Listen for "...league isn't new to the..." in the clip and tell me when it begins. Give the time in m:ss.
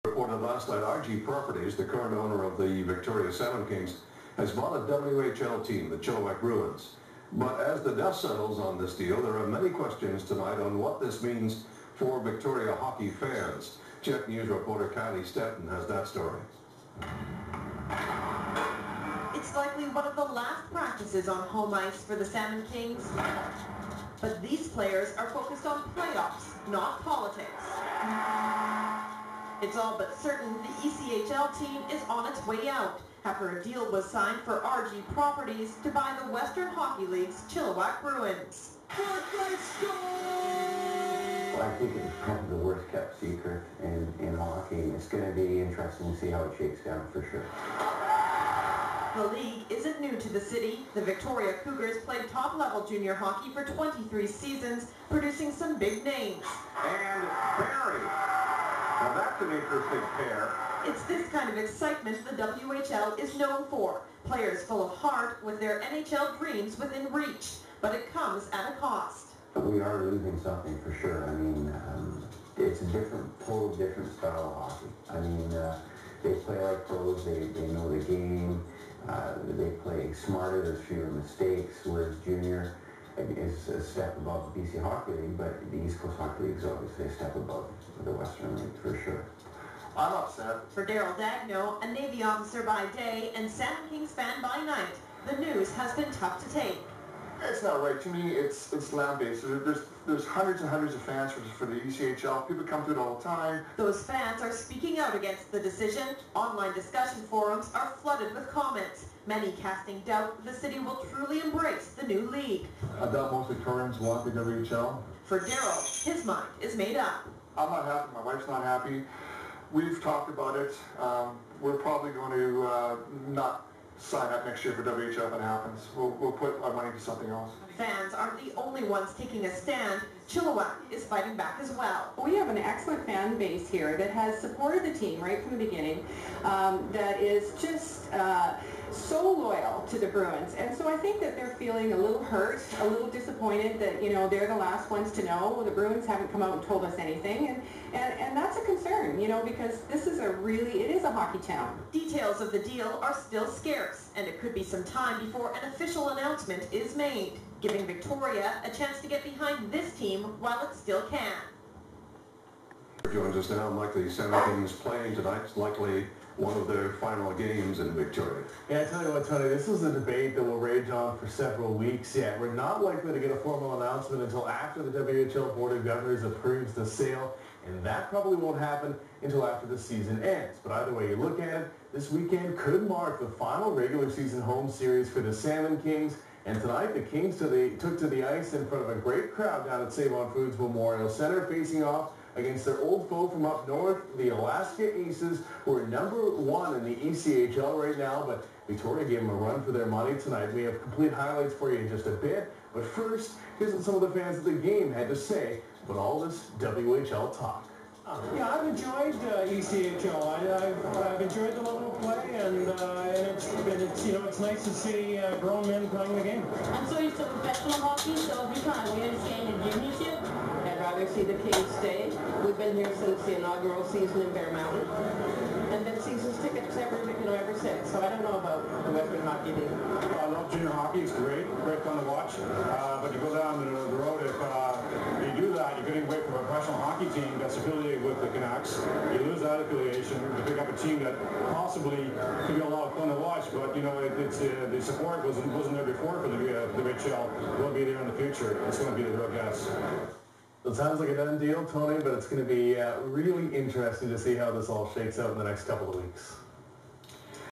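0:49.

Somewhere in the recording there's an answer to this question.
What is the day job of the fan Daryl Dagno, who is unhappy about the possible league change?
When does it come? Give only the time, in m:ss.
1:31.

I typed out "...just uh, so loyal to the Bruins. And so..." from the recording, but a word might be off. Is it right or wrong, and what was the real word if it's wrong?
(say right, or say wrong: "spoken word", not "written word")
right.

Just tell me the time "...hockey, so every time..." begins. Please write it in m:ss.
3:37.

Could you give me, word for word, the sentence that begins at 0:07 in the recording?
But as the dust settles on this deal, there are many questions tonight on what this means for Victoria hockey fans.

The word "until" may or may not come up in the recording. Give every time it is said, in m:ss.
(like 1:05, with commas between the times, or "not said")
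2:54, 2:59.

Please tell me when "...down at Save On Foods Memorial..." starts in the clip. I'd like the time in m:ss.
3:09.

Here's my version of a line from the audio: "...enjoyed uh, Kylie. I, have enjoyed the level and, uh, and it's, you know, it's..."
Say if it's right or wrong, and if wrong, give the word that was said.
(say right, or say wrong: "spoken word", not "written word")
wrong: "ECHL", not "Kylie".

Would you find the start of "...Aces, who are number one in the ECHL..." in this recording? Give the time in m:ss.
3:15.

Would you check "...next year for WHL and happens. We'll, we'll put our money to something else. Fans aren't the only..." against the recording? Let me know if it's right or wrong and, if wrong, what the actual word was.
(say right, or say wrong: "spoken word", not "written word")
right.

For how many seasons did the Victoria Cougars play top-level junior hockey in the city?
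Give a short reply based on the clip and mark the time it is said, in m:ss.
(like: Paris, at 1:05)
23, at 0:53.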